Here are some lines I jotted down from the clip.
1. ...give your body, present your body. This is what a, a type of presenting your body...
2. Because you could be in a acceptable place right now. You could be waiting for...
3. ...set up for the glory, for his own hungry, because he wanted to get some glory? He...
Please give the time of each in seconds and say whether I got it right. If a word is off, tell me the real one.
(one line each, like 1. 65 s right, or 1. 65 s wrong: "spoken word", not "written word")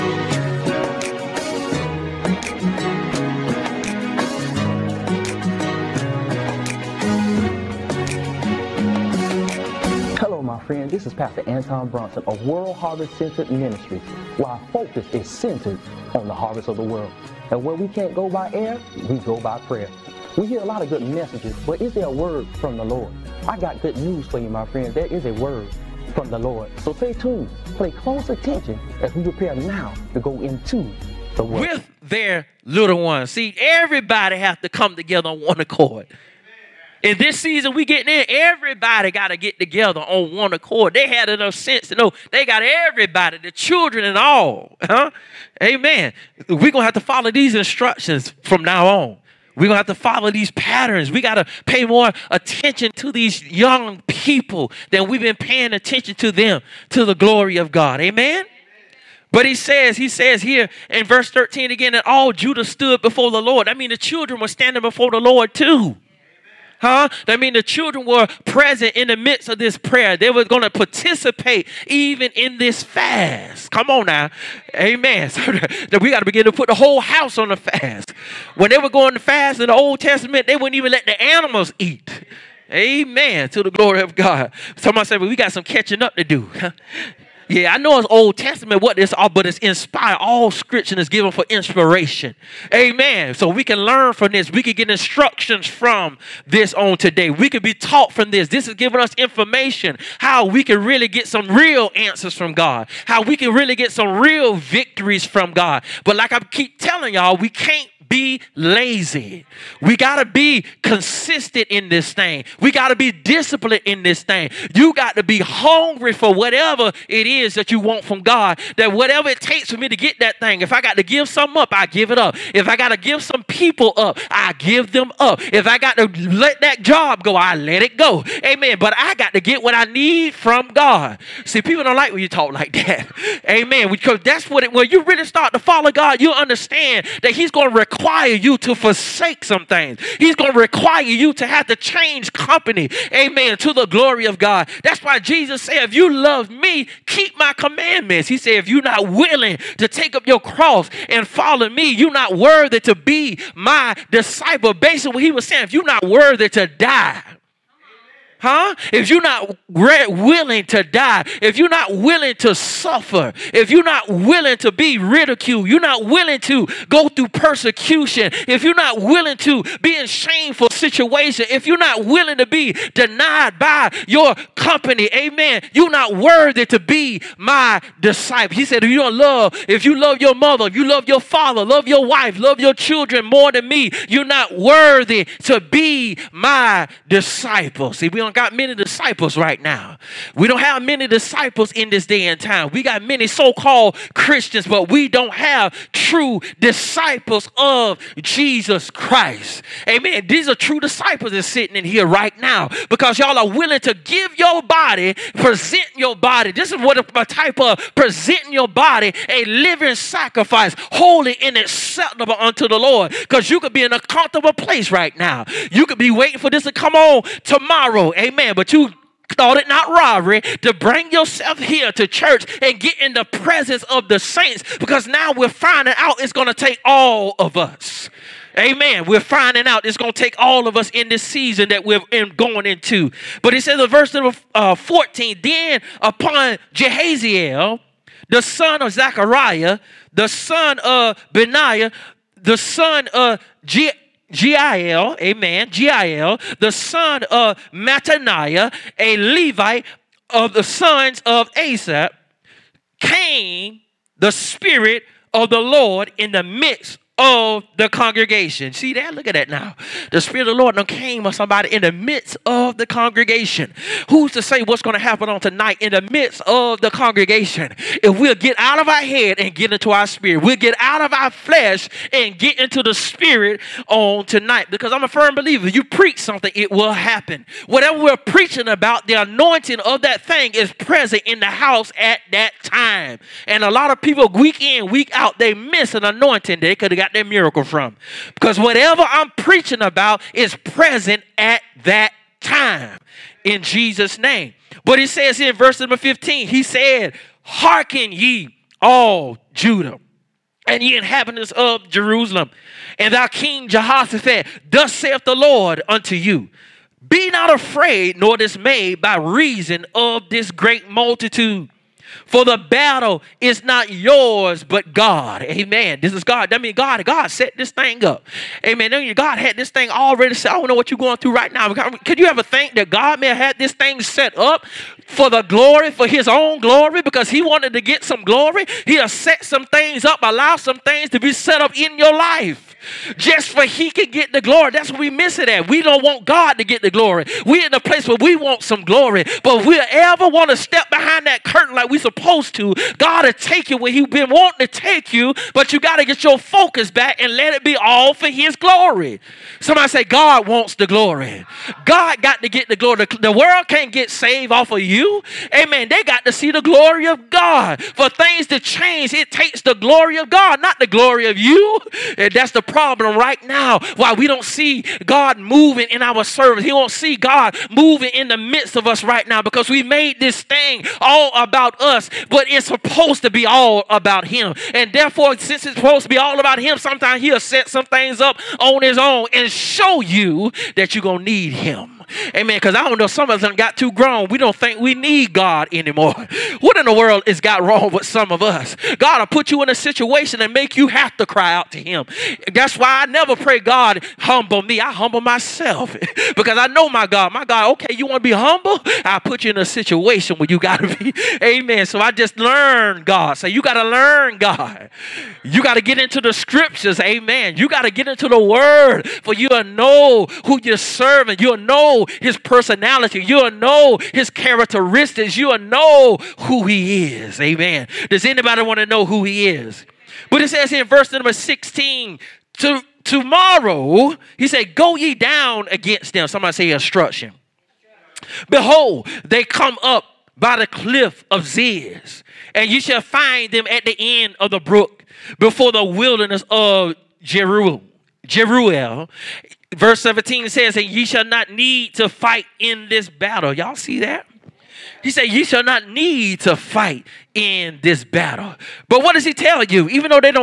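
1. 203 s right
2. 213 s wrong: "comfortable", not "acceptable"
3. 324 s wrong: "glory", not "hungry".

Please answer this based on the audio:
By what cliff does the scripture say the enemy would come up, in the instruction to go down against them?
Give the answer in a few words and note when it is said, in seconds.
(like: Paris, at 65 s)
the cliff of Ziz, at 430 s.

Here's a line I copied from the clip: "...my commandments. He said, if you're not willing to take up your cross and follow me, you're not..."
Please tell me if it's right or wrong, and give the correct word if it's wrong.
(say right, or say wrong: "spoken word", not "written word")
right.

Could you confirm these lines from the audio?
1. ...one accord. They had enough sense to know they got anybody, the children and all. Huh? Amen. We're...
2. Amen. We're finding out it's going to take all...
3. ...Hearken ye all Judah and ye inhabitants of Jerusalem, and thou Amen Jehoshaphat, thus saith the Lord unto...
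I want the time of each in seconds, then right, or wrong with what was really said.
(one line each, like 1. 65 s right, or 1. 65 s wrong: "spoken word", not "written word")
1. 40 s wrong: "everybody", not "anybody"
2. 228 s right
3. 297 s wrong: "King", not "Amen".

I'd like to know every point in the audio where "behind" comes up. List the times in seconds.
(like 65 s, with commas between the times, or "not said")
340 s.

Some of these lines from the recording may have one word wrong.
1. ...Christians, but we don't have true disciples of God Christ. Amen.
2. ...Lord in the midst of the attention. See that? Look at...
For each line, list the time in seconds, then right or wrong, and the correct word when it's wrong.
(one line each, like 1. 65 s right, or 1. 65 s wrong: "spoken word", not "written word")
1. 194 s wrong: "Jesus", not "God"
2. 255 s wrong: "congregation", not "attention".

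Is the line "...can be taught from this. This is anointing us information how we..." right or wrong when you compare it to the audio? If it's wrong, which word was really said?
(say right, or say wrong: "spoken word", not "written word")
wrong: "giving", not "anointing".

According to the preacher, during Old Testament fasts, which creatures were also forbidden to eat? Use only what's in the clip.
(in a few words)
the animals.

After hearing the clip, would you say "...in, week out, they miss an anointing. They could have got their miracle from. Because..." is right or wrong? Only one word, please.
right.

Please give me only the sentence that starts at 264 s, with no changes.
Who's to say what's going to happen on tonight in the midst of the congregation?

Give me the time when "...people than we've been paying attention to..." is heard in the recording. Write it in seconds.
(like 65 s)
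54 s.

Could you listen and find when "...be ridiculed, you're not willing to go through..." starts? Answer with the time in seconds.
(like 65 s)
164 s.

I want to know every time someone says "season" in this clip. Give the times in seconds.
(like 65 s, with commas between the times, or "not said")
37 s, 231 s.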